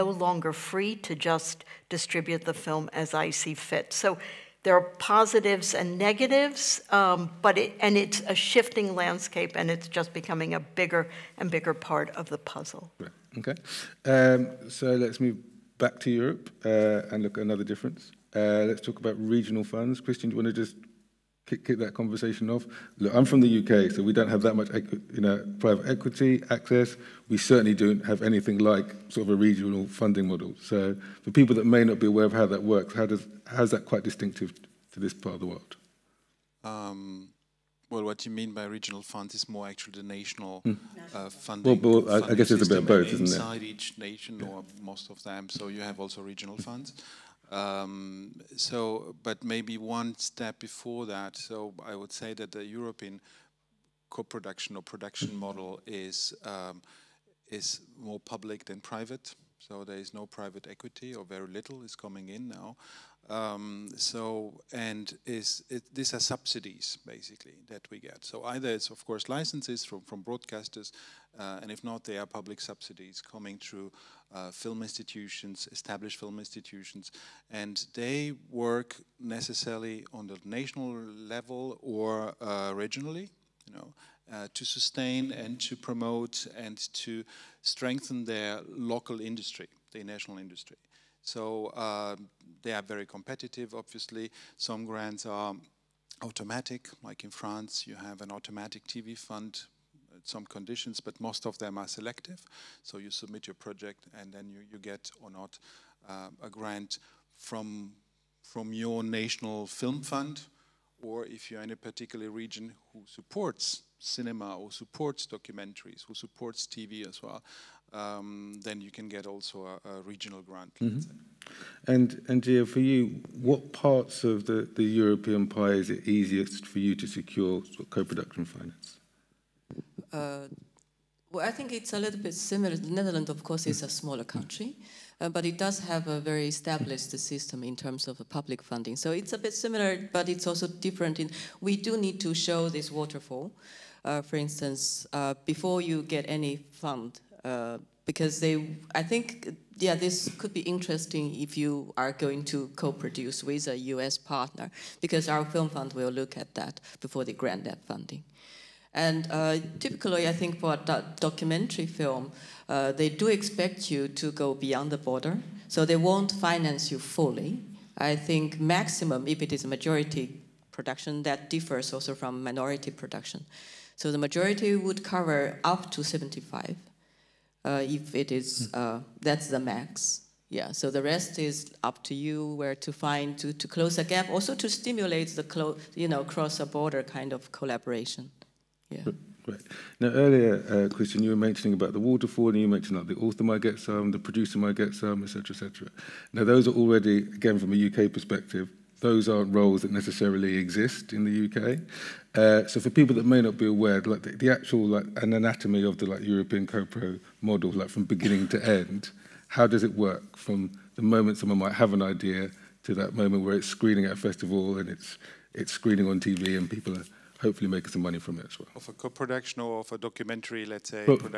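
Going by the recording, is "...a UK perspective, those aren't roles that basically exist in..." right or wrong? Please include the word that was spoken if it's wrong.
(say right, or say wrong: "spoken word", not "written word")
wrong: "necessarily", not "basically".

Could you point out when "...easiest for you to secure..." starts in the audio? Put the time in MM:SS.
02:06.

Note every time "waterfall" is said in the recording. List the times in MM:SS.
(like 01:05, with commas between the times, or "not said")
02:22, 03:11.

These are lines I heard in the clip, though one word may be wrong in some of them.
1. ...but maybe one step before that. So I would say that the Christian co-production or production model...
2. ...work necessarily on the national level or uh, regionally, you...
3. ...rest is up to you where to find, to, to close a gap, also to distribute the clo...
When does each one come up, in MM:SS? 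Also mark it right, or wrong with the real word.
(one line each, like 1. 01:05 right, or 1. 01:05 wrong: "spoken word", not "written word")
1. 00:49 wrong: "European", not "Christian"
2. 01:18 right
3. 03:01 wrong: "stimulate", not "distribute".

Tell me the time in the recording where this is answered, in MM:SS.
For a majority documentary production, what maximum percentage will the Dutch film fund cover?
02:56.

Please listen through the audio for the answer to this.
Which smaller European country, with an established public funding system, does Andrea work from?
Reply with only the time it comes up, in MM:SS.
02:12.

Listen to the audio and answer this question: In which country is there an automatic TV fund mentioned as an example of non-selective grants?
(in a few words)
France.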